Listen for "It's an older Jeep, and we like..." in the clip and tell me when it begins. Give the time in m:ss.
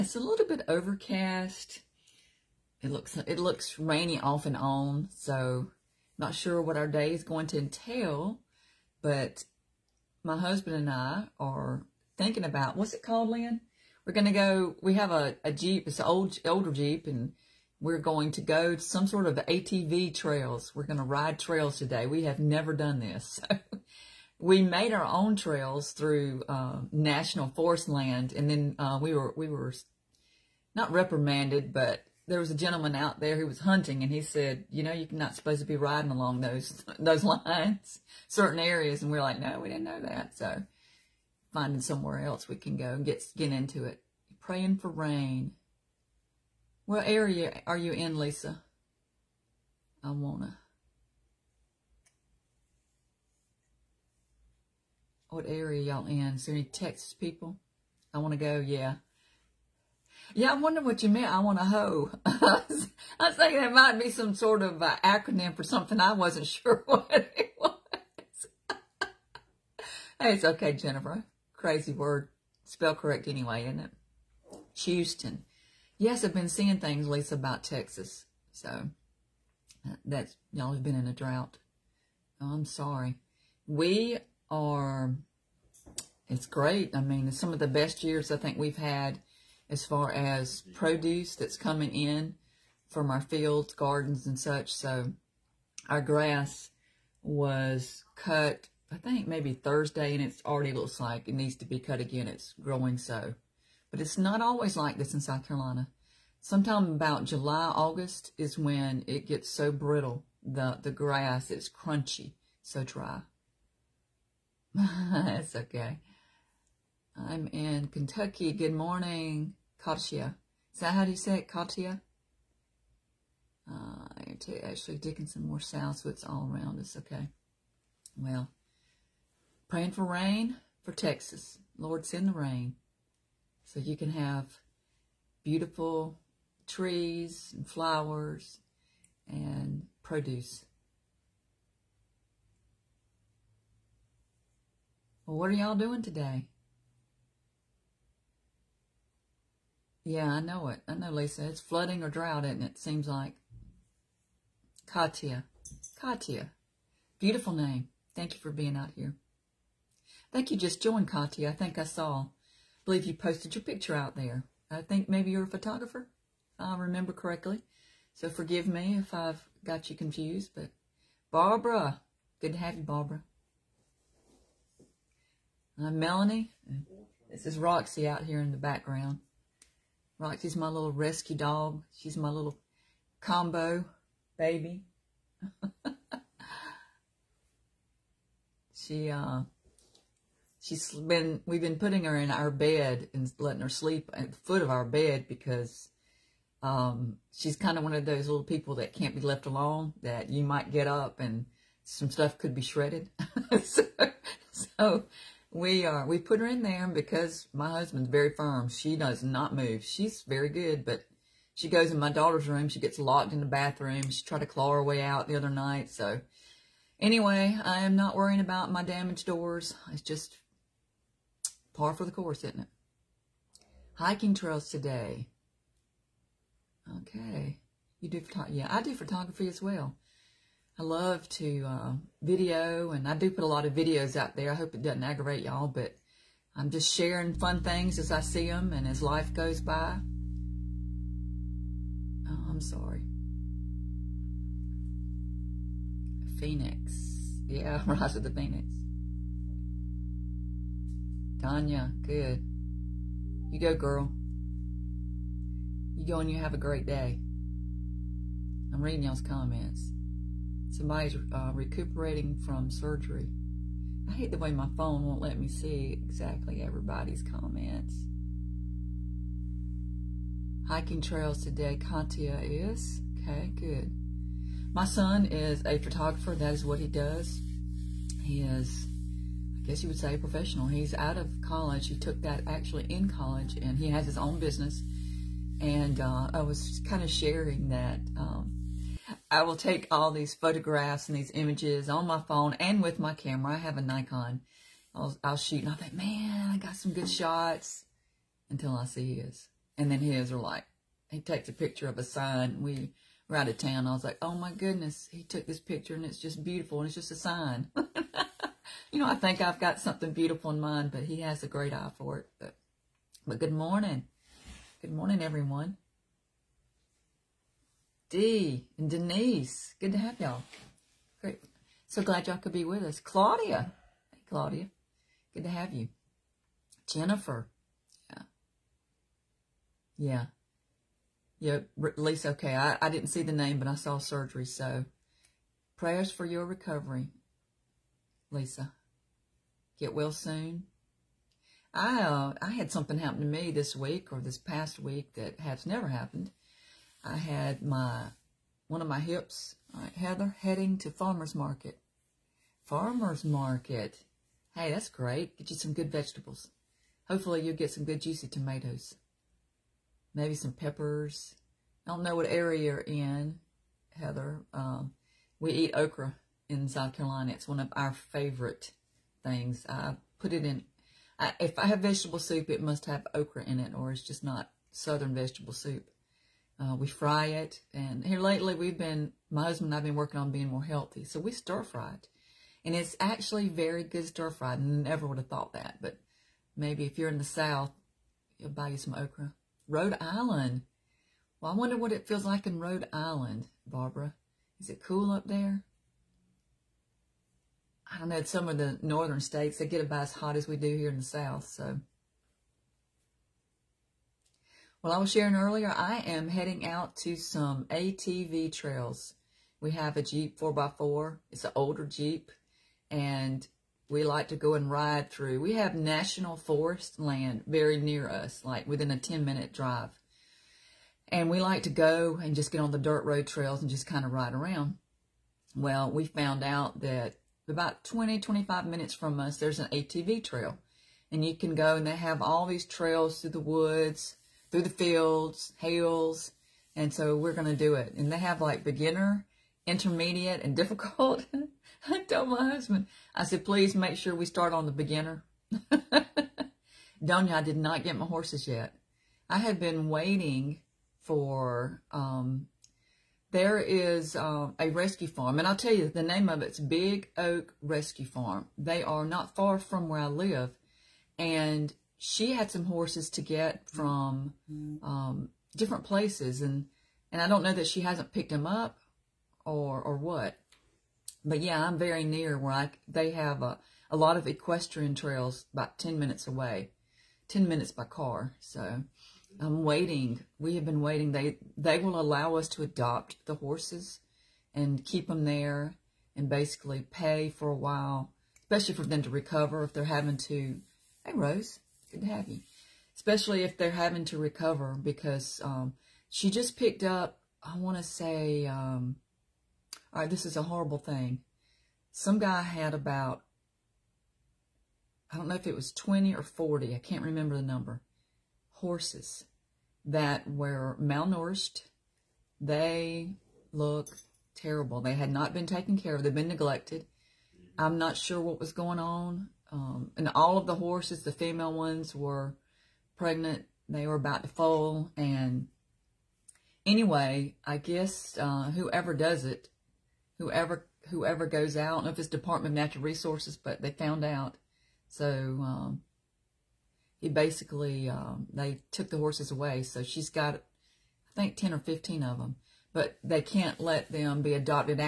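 6:51.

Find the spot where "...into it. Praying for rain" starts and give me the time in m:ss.
0:43.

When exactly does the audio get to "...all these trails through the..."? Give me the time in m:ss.
7:12.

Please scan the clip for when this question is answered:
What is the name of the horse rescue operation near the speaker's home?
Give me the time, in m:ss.
7:36.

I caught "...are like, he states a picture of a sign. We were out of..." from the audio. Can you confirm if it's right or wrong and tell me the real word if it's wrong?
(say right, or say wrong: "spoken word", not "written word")
wrong: "takes", not "states".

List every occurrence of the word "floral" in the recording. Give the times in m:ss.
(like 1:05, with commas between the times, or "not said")
not said.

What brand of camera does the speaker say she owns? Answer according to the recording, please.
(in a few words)
Nikon.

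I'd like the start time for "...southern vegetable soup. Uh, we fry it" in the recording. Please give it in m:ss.
6:14.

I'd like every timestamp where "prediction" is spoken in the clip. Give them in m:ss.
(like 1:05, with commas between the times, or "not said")
not said.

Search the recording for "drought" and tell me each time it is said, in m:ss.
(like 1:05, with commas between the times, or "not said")
1:21, 2:32.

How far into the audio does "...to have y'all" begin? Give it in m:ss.
5:19.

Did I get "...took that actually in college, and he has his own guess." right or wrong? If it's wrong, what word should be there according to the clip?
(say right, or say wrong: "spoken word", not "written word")
wrong: "business", not "guess".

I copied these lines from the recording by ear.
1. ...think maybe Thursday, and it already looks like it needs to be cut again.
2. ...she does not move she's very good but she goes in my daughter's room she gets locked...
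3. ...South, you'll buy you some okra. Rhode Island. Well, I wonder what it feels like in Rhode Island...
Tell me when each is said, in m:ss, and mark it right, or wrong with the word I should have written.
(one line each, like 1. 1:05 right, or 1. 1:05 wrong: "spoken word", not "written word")
1. 1:38 right
2. 3:28 right
3. 6:27 right.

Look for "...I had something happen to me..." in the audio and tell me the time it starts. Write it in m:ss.
5:42.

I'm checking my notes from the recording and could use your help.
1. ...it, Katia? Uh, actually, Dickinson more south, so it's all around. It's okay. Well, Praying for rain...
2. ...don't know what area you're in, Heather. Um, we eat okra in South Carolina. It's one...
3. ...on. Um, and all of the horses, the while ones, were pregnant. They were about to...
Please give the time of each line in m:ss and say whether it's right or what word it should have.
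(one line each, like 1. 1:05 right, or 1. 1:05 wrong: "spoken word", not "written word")
1. 2:01 right
2. 6:01 right
3. 8:38 wrong: "female", not "while".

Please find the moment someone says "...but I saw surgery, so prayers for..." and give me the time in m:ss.
5:33.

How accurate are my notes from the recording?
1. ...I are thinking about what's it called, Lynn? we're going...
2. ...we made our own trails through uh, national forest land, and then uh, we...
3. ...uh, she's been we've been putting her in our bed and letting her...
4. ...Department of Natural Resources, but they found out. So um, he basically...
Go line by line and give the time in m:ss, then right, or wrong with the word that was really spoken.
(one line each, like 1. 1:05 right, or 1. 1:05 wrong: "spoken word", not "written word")
1. 0:10 right
2. 0:24 right
3. 3:09 right
4. 8:52 right.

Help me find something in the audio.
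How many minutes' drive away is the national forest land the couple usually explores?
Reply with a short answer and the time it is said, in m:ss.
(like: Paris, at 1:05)
10, at 6:58.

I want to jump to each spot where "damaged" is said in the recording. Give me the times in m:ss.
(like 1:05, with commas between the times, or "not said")
3:38.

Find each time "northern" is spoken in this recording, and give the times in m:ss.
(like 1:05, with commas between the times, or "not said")
6:38.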